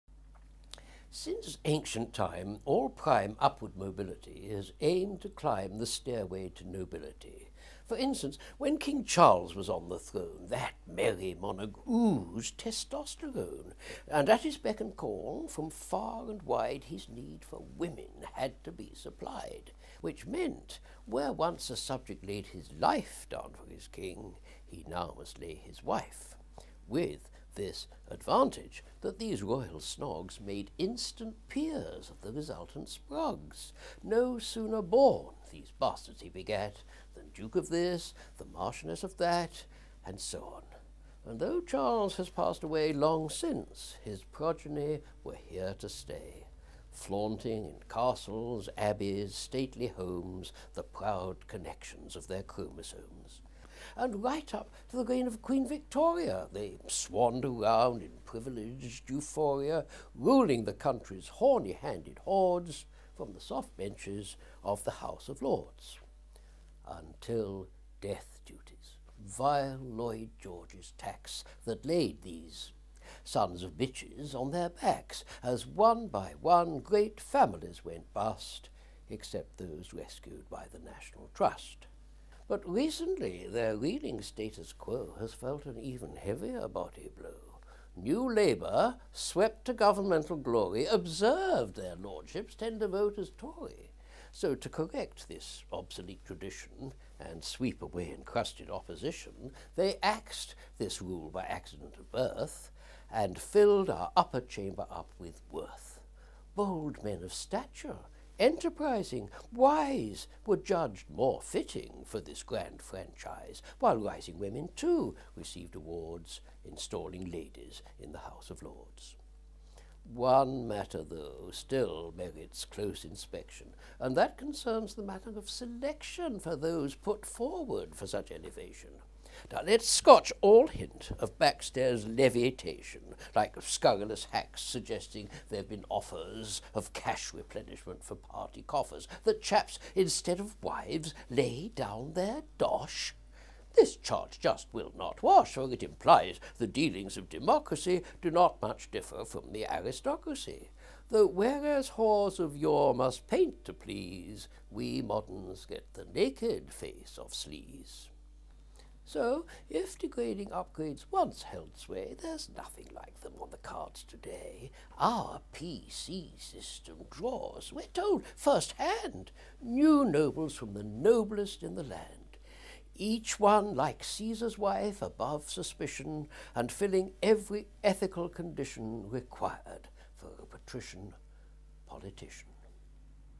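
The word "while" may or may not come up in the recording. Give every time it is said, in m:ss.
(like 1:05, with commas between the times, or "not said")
1:53.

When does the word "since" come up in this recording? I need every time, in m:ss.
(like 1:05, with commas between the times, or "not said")
0:01, 0:43.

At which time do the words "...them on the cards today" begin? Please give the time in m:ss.
2:43.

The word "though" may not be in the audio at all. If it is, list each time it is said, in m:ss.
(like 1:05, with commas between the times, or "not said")
0:41, 2:01, 2:31.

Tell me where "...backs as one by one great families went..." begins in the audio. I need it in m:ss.
1:14.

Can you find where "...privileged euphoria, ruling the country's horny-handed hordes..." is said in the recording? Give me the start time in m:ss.
0:58.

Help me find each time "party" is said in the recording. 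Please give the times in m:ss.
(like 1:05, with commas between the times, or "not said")
2:18.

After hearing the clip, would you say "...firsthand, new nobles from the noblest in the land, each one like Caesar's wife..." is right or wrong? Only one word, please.
right.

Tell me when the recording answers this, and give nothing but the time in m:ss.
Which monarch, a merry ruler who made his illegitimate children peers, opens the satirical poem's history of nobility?
0:08.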